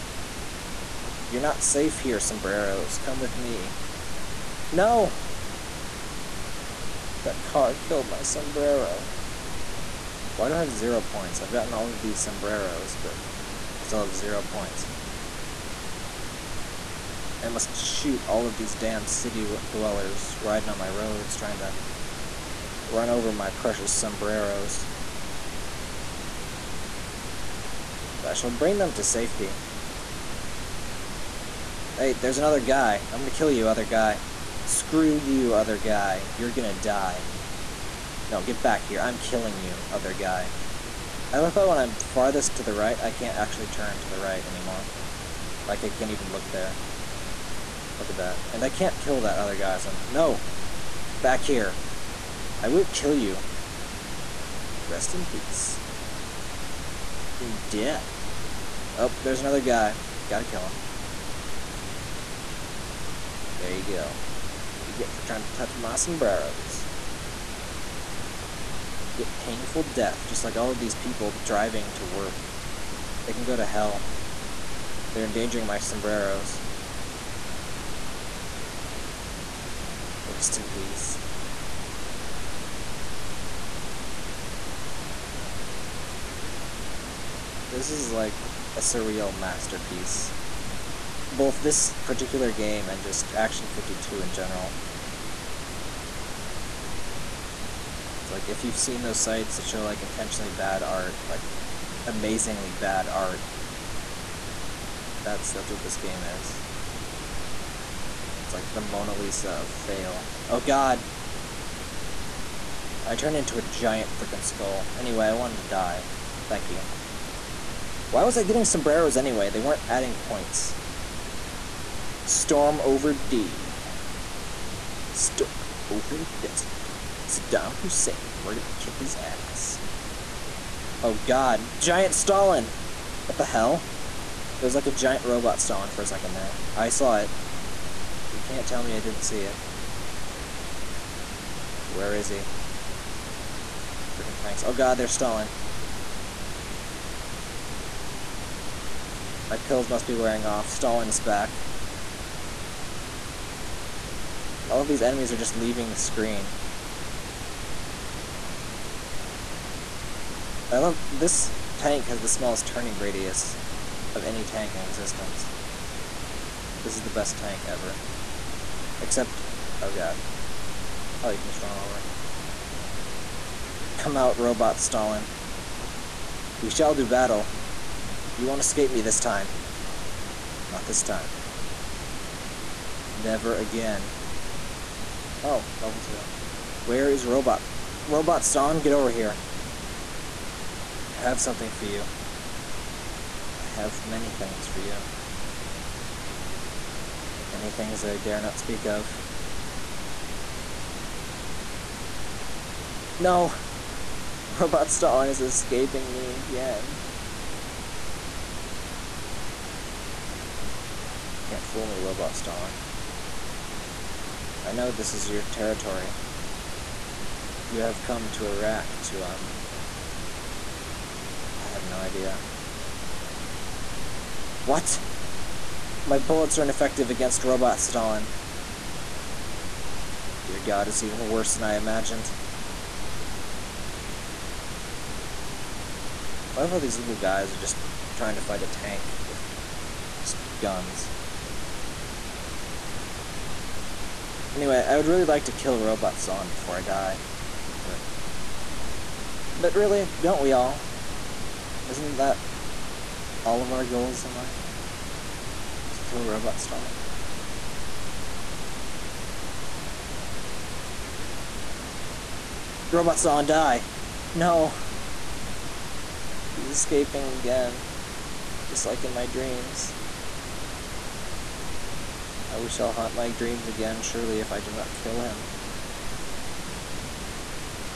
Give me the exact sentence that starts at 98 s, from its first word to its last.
It's like if you've seen those sites that show like intentionally bad art, like amazingly bad art.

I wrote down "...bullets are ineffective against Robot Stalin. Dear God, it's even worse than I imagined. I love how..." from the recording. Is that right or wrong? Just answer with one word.
right.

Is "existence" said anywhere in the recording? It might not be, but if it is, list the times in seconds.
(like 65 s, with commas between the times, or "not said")
164 s.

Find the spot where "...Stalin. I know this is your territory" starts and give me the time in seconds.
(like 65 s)
212 s.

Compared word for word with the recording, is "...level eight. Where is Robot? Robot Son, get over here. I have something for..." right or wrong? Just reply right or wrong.
wrong.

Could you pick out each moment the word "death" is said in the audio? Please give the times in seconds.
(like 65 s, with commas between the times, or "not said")
57 s, 69 s.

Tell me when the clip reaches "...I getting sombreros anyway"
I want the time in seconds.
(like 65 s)
118 s.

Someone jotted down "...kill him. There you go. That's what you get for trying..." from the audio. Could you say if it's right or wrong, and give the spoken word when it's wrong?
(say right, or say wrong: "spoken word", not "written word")
right.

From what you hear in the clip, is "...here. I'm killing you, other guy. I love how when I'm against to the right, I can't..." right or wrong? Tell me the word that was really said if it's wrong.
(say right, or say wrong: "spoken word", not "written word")
wrong: "farthest", not "against".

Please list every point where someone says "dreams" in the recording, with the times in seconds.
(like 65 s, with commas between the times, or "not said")
269 s, 273 s.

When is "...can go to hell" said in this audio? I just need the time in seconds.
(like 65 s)
73 s.